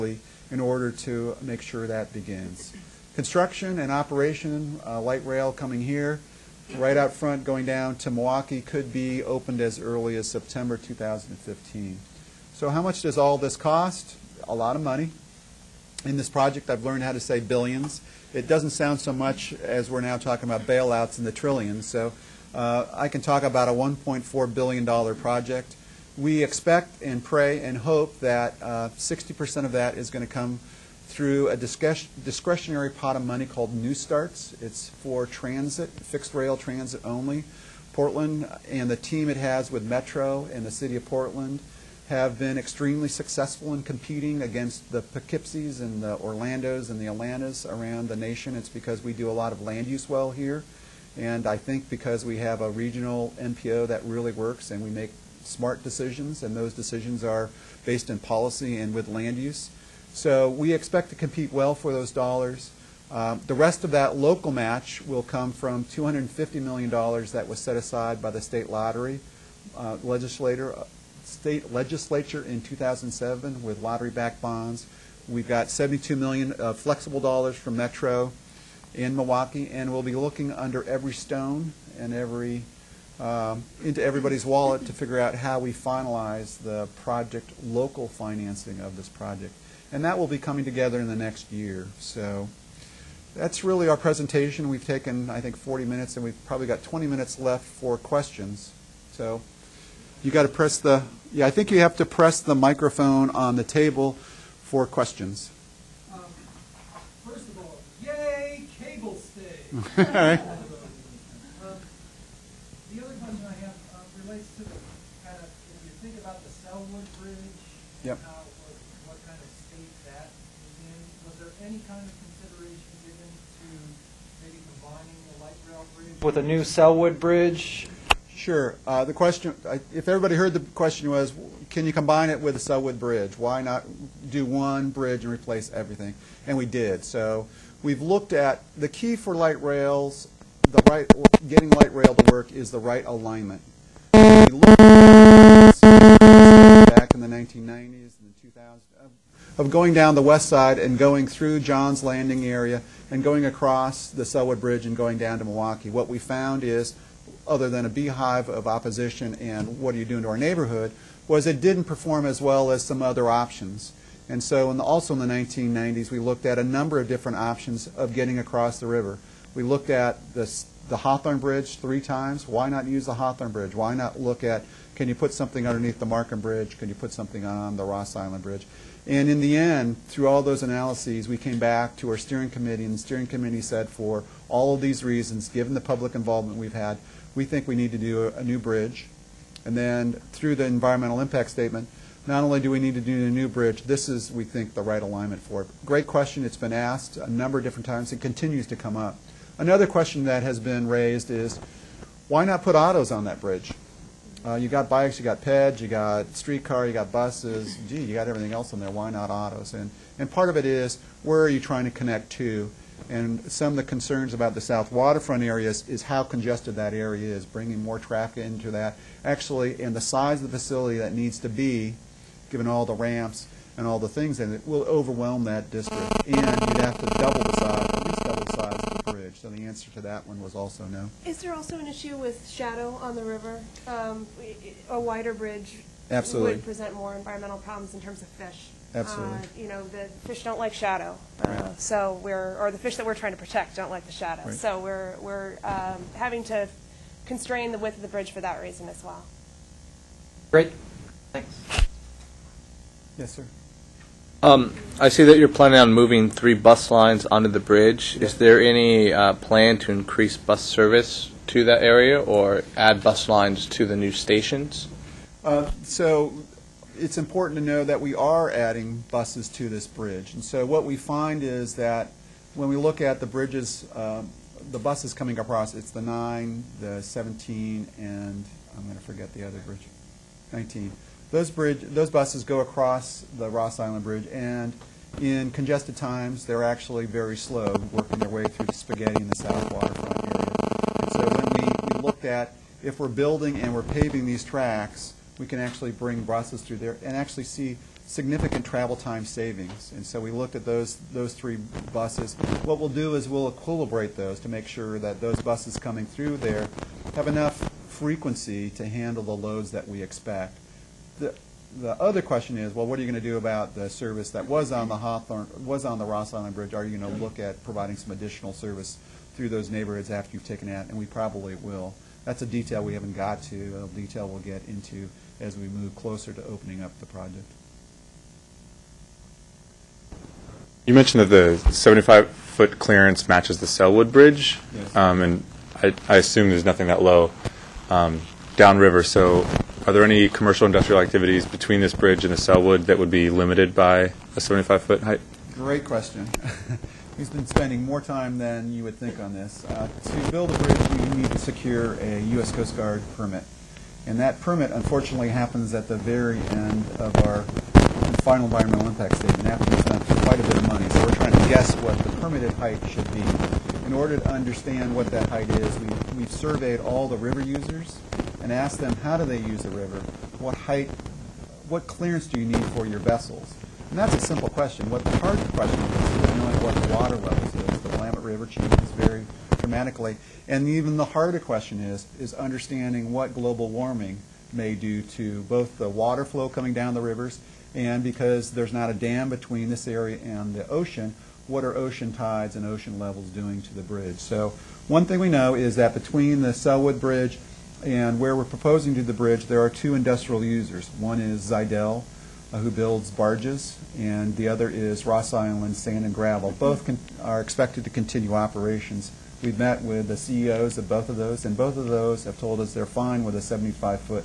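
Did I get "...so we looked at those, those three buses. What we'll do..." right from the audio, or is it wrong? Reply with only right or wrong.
right.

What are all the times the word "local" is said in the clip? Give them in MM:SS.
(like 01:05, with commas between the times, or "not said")
01:04, 01:27.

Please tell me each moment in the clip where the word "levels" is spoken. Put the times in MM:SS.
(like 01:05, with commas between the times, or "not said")
06:17, 06:32.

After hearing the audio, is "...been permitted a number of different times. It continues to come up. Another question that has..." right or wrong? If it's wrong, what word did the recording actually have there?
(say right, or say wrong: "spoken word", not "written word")
wrong: "asked", not "permitted".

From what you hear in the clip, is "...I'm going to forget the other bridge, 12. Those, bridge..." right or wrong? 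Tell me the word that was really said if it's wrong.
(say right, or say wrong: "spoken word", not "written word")
wrong: "19", not "12".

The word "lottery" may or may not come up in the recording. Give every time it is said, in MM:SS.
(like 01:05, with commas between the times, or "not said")
01:08, 01:13.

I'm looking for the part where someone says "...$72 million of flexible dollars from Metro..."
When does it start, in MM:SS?
01:15.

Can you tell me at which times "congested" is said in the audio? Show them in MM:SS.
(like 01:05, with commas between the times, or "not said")
03:36, 04:45.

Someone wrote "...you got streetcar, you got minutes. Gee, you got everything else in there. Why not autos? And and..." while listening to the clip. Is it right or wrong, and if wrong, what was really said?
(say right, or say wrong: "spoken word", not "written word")
wrong: "buses", not "minutes".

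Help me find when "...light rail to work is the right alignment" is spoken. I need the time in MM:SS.
02:21.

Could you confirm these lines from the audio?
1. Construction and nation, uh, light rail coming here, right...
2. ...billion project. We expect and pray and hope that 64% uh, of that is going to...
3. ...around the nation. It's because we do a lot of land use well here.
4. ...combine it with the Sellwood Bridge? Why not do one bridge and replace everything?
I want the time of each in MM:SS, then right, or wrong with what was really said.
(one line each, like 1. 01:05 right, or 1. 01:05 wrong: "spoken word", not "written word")
1. 00:03 wrong: "operation", not "nation"
2. 00:24 wrong: "60", not "64"
3. 00:47 right
4. 02:11 right.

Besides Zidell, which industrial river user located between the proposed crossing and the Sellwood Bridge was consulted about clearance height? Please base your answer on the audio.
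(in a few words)
Ross Island Sand and Gravel.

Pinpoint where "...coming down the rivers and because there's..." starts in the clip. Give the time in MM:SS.
06:26.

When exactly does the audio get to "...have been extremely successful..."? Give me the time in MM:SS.
00:42.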